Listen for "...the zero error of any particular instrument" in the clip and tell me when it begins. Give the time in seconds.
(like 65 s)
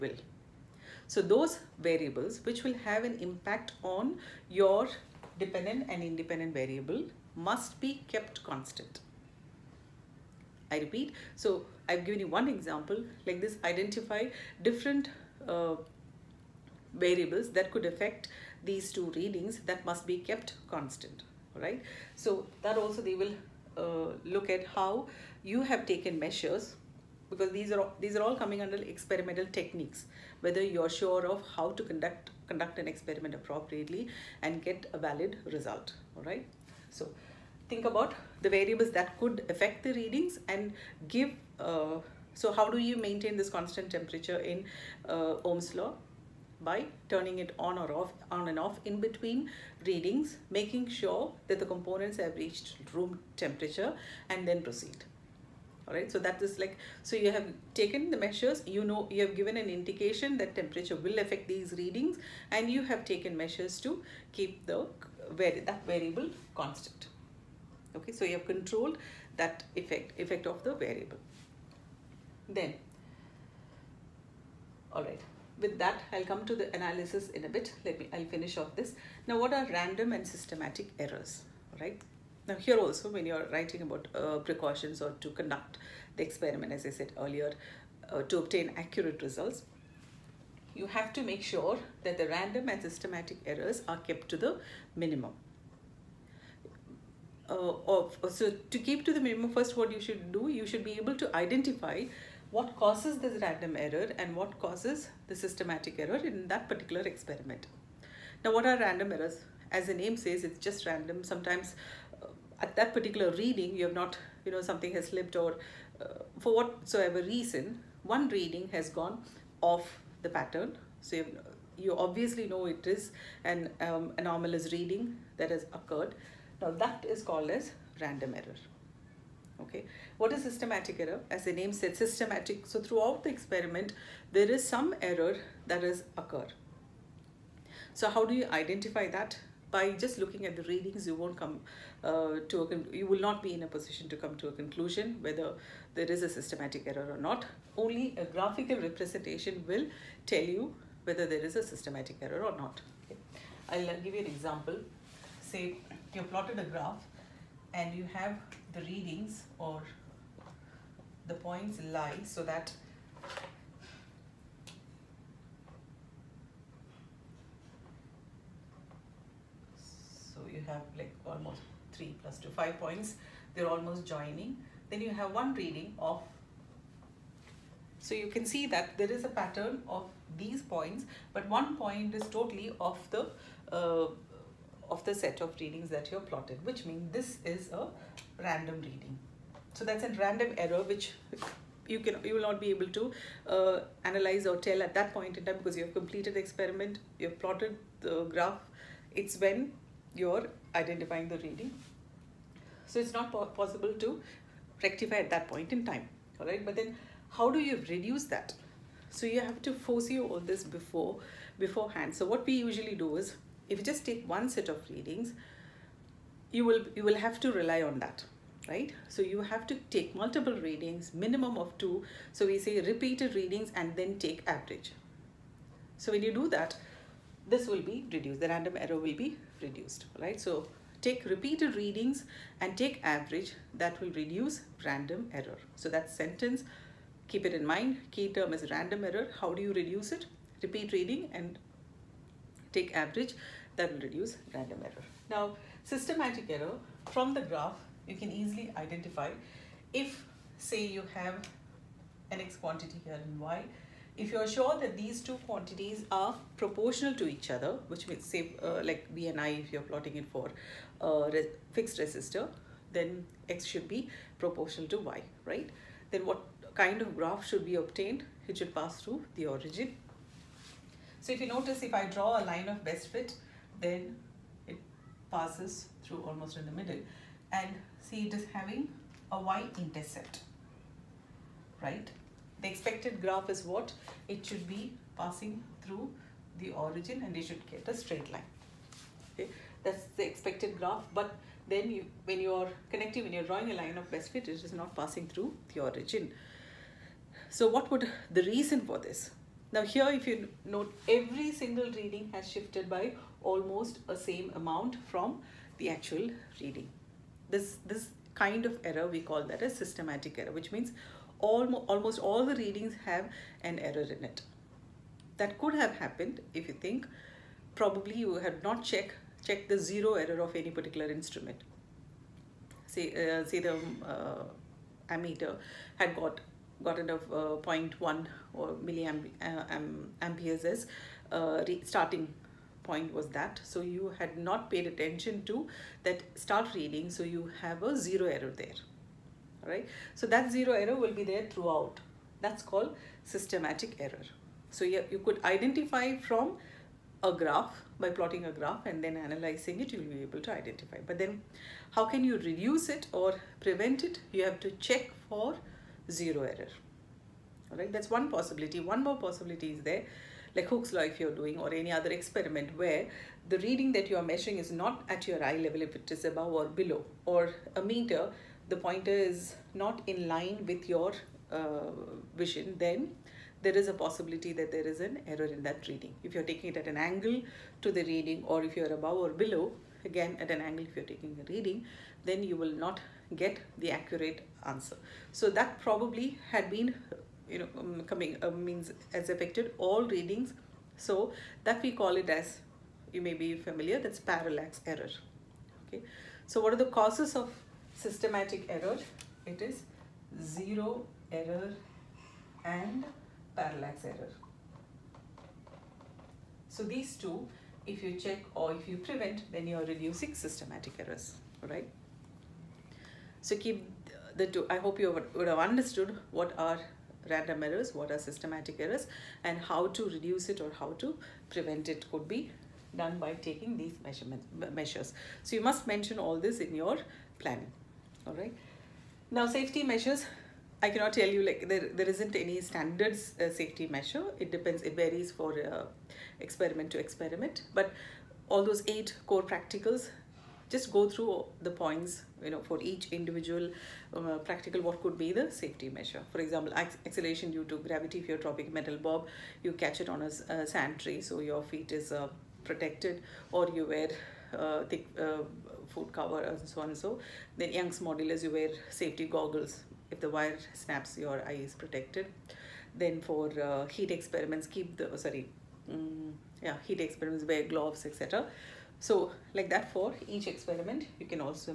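319 s.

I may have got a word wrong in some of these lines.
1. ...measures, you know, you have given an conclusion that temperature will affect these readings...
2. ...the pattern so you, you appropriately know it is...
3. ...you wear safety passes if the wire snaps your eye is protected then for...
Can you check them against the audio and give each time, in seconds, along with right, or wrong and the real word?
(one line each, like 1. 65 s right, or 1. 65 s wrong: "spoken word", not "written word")
1. 58 s wrong: "indication", not "conclusion"
2. 120 s wrong: "obviously", not "appropriately"
3. 458 s wrong: "goggles", not "passes".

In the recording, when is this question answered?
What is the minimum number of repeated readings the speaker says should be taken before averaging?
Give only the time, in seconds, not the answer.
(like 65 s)
221 s.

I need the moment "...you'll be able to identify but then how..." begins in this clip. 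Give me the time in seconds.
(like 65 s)
349 s.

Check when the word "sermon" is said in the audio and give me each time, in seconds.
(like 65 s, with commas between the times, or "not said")
not said.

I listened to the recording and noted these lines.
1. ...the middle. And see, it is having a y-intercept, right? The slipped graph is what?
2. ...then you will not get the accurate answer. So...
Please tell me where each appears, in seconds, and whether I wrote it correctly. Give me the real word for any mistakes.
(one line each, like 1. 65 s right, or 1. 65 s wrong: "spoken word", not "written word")
1. 276 s wrong: "expected", not "slipped"
2. 382 s right.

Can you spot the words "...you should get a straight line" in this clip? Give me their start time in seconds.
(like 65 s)
287 s.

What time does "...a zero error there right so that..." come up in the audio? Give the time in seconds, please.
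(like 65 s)
337 s.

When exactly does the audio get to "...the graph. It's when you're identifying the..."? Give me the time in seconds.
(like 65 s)
198 s.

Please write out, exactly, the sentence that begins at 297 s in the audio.
So what would the reason for this?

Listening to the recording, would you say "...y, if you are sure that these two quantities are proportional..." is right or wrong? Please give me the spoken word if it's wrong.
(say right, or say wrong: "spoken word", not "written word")
right.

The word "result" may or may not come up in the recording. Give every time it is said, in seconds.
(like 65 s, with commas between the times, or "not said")
35 s, 89 s.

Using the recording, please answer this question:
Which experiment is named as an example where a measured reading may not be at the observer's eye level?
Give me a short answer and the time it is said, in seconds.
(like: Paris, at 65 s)
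Hooke's law, at 360 s.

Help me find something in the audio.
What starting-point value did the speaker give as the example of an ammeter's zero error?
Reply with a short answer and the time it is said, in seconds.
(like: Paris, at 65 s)
0.1, at 327 s.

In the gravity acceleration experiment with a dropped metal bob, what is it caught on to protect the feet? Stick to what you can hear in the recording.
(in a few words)
A sand tray.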